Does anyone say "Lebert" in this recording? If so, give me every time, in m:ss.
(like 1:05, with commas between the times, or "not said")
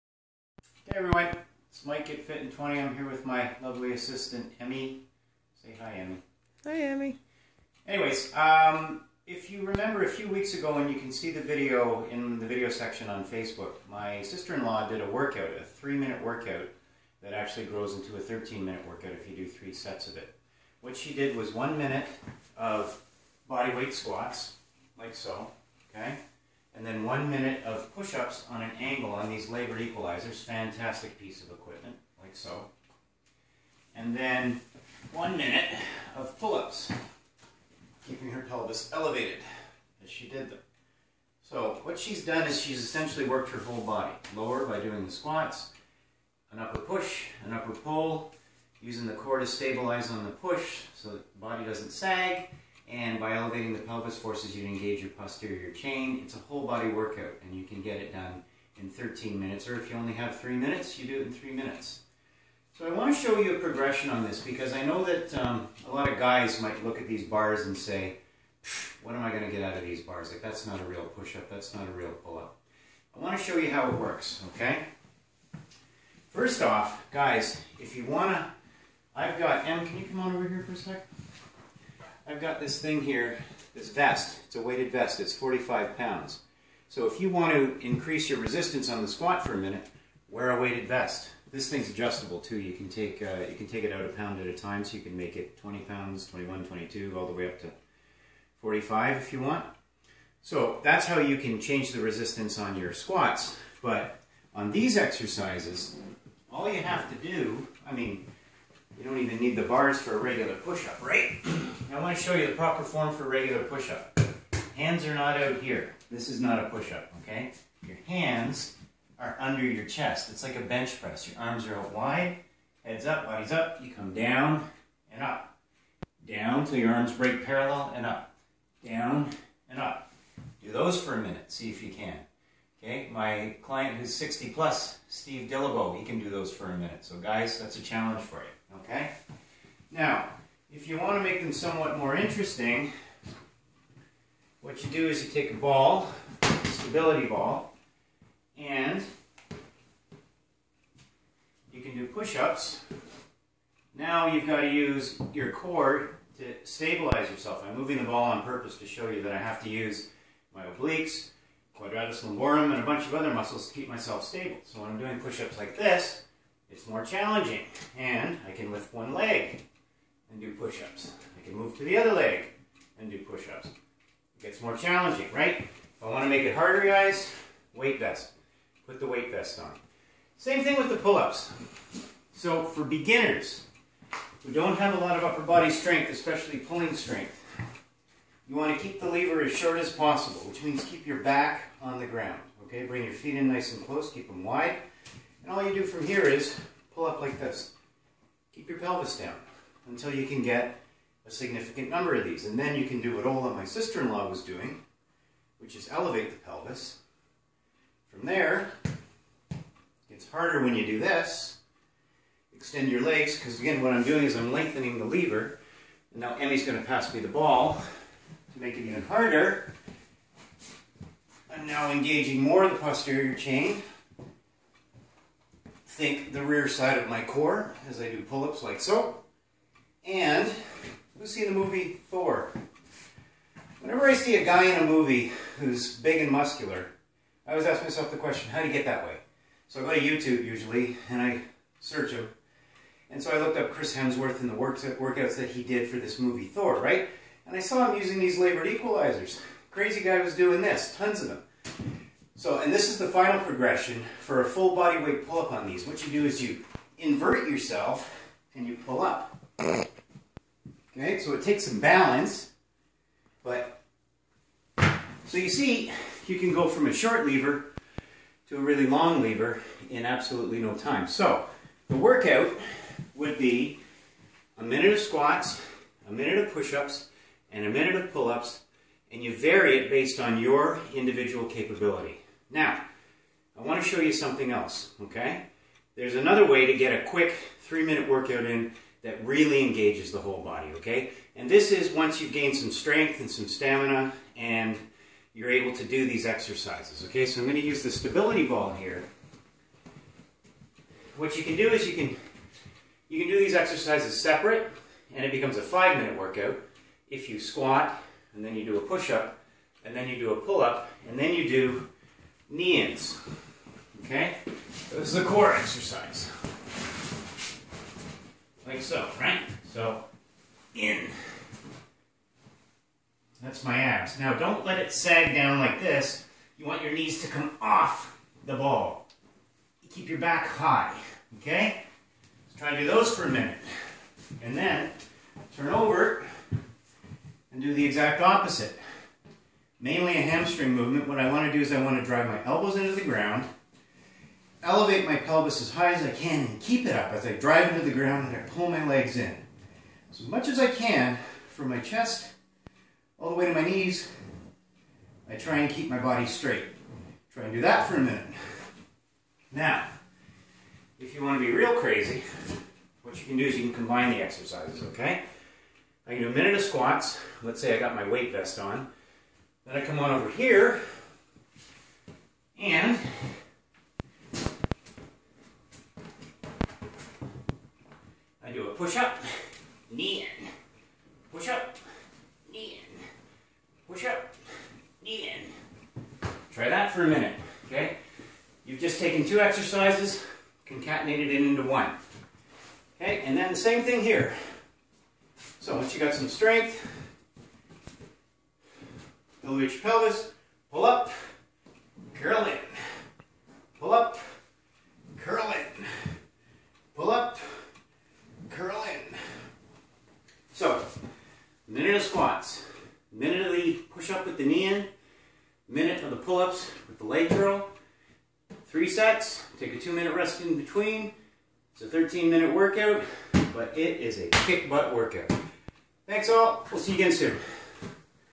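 0:29, 4:08.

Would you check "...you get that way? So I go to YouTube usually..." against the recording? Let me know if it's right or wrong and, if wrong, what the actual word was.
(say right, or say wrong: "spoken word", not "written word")
right.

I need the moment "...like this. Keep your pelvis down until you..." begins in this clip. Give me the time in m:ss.
3:17.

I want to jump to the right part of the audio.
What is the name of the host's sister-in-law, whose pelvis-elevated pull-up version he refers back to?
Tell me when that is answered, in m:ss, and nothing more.
3:23.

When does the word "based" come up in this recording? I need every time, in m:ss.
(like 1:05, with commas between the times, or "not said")
4:39.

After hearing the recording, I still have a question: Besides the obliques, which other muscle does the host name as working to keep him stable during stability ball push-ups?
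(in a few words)
quadratus lumborum.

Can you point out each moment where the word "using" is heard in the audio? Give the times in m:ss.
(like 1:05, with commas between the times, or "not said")
0:48, 4:08.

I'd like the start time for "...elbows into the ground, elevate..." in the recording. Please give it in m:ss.
5:42.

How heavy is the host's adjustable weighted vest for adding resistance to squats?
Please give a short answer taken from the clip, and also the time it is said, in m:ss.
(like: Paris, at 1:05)
45 pounds, at 1:25.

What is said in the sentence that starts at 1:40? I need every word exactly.
So that's how you can change the resistance on your squats.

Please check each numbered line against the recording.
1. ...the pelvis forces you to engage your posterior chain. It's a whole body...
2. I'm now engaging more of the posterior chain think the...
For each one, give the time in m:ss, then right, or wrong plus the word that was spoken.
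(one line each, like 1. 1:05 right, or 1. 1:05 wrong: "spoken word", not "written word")
1. 0:53 right
2. 3:41 right.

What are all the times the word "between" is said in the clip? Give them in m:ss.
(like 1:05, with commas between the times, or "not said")
7:00.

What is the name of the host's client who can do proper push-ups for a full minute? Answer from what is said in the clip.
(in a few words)
Steve Dillabo.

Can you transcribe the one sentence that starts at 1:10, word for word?
Like that's not a real push-up, that's not a real pull-up.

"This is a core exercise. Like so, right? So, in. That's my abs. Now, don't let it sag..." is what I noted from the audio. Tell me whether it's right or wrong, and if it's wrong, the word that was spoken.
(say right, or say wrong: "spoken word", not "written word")
right.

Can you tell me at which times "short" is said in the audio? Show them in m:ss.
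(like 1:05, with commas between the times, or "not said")
3:09, 4:26.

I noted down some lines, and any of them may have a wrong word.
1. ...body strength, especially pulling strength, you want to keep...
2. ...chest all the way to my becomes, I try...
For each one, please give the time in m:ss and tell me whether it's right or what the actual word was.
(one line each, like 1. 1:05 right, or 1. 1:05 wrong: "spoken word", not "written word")
1. 3:05 right
2. 5:51 wrong: "knees", not "becomes".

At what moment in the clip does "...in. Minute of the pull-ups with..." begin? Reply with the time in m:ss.
6:54.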